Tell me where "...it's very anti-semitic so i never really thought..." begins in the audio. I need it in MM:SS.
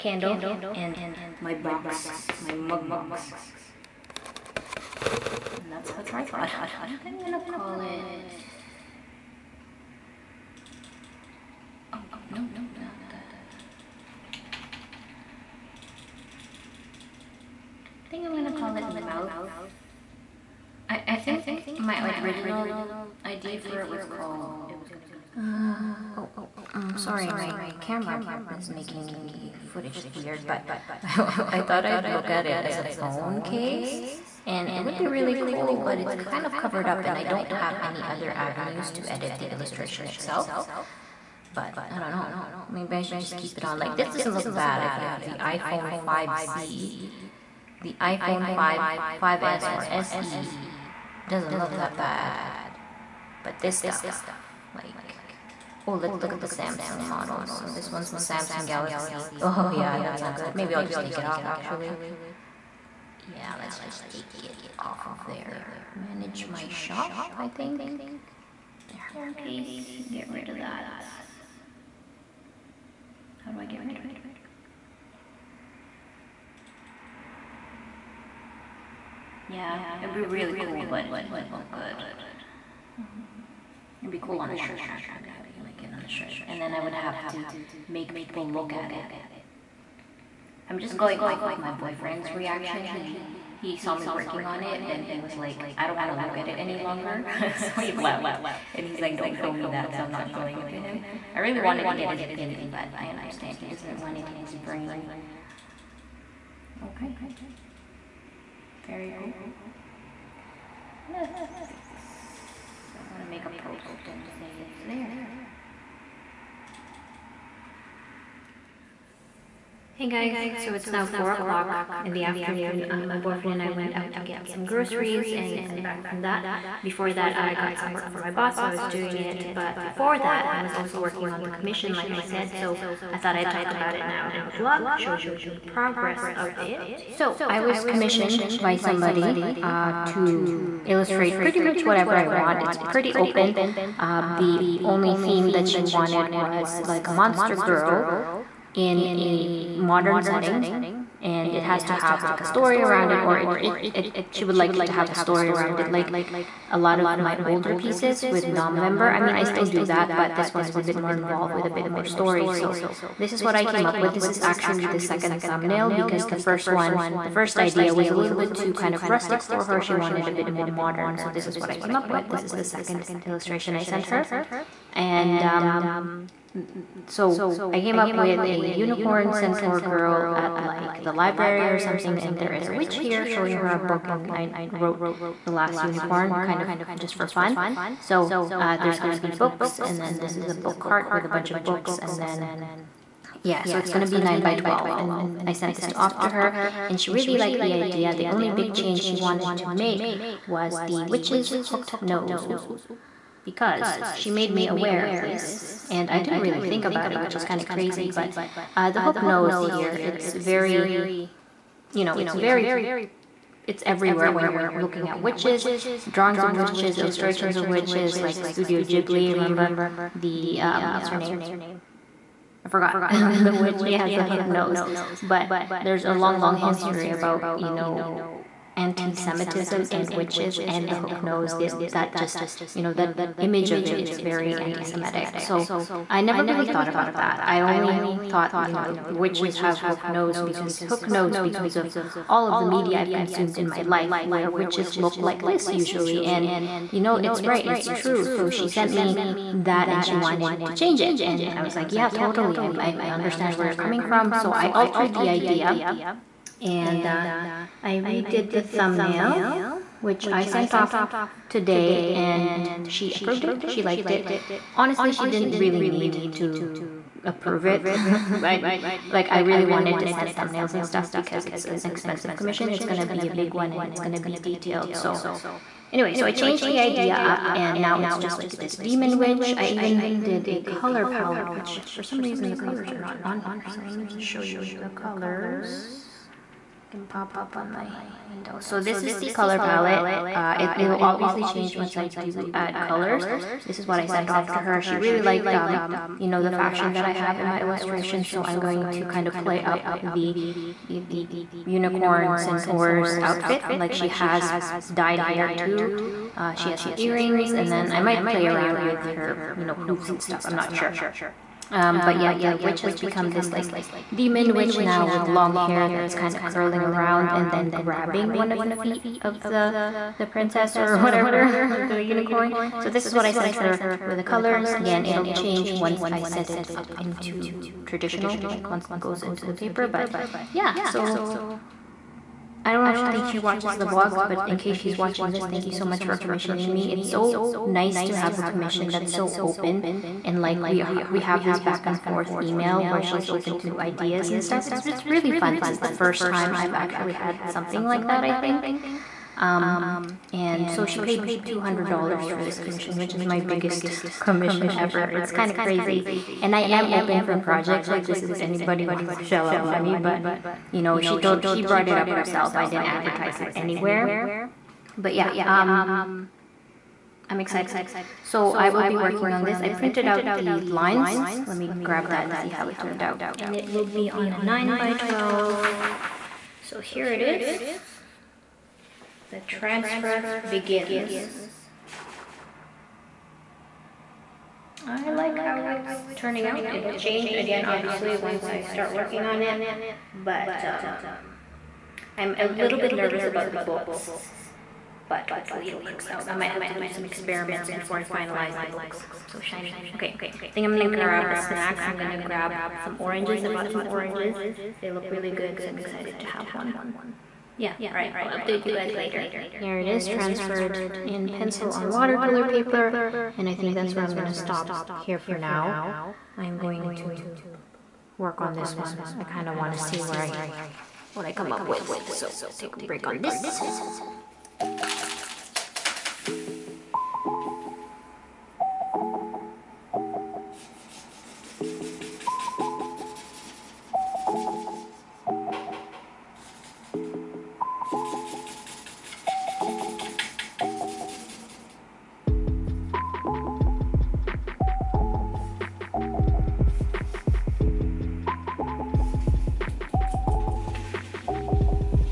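03:53.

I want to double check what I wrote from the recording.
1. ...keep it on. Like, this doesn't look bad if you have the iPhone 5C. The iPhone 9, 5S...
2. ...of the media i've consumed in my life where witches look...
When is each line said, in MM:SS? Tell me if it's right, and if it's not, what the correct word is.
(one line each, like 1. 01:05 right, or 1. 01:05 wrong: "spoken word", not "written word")
1. 00:43 wrong: "5", not "9"
2. 04:02 right.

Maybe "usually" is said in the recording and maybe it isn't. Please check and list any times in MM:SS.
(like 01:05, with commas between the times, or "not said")
04:05.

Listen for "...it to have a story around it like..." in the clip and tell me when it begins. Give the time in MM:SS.
02:34.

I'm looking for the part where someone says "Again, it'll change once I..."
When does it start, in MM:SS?
05:24.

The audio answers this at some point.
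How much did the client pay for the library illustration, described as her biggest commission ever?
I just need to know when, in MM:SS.
05:51.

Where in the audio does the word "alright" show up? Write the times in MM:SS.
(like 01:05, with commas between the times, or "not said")
06:47.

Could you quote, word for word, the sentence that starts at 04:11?
And I was like, yeah, totally.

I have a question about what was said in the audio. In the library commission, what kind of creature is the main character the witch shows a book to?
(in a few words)
Unicorn centaur girl.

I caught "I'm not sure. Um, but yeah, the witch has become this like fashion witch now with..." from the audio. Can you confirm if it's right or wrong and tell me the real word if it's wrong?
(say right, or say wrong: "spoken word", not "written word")
wrong: "demon", not "fashion".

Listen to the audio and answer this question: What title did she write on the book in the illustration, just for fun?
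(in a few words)
The Last Unicorn.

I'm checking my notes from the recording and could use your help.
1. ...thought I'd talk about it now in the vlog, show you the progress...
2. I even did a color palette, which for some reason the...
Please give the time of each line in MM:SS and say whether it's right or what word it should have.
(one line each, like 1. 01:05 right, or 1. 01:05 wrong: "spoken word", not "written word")
1. 02:13 right
2. 04:39 right.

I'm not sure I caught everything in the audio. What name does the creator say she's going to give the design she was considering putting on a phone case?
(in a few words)
Mouth.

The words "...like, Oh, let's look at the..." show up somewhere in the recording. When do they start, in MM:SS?
00:54.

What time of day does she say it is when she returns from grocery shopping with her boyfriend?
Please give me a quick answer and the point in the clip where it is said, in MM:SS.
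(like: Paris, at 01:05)
4 o'clock in the afternoon, at 02:01.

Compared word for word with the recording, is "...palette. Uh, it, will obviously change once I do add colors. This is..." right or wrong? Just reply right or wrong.
right.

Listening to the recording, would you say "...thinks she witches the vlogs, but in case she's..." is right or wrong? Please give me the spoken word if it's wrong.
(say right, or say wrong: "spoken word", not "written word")
wrong: "watches", not "witches".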